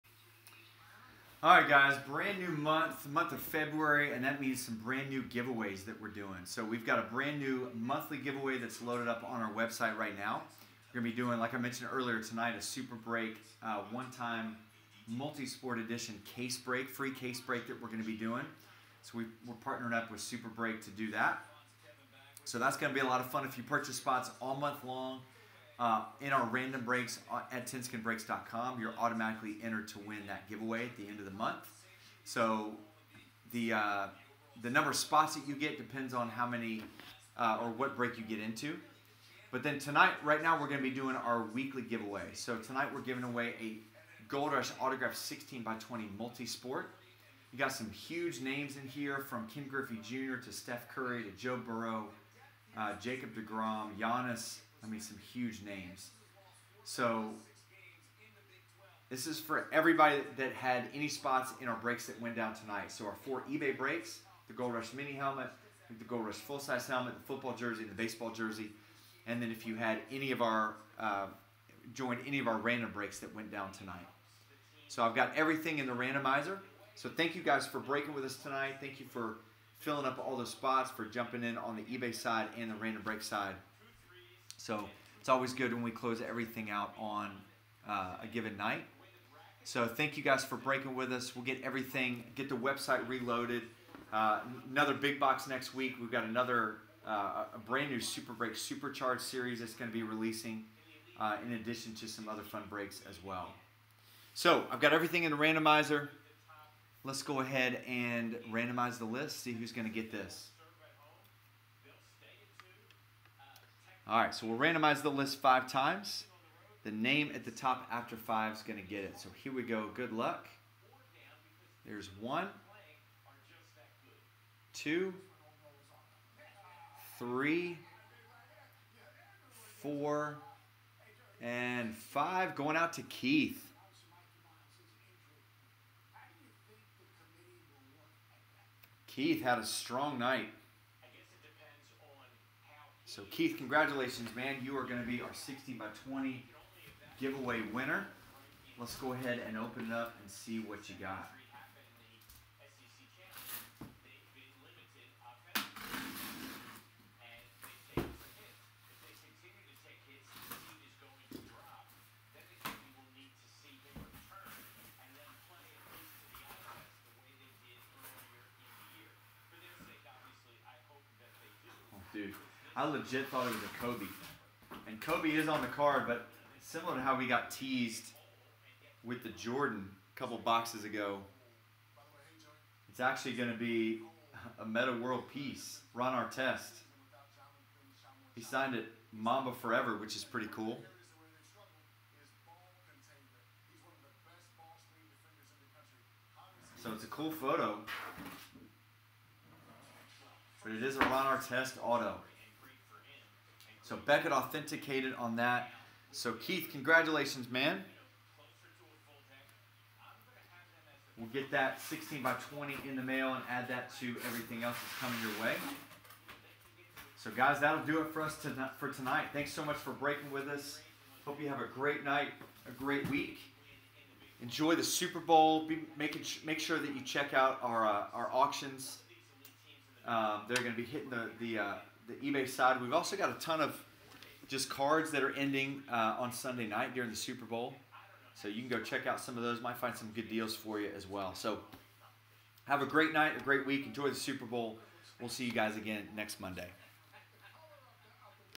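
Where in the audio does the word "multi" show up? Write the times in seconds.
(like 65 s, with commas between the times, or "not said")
15 s, 46 s.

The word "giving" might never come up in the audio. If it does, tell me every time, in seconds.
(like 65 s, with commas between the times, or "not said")
43 s.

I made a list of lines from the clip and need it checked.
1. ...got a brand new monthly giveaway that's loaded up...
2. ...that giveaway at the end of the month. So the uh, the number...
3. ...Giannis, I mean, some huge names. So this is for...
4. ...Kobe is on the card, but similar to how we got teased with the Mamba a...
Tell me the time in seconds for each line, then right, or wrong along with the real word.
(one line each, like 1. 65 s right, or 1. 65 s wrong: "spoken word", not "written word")
1. 6 s right
2. 30 s right
3. 53 s right
4. 175 s wrong: "Jordan", not "Mamba".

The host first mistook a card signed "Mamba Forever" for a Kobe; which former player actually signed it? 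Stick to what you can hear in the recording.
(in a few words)
Metta World Peace.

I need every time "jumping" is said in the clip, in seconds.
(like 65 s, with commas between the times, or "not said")
81 s.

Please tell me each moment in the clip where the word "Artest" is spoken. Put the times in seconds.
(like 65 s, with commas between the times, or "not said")
186 s, 201 s.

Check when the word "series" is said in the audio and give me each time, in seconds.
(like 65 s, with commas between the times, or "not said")
99 s.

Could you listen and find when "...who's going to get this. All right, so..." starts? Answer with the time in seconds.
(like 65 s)
109 s.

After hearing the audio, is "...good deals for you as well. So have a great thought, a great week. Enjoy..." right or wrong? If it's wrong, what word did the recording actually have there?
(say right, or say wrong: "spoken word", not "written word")
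wrong: "night", not "thought".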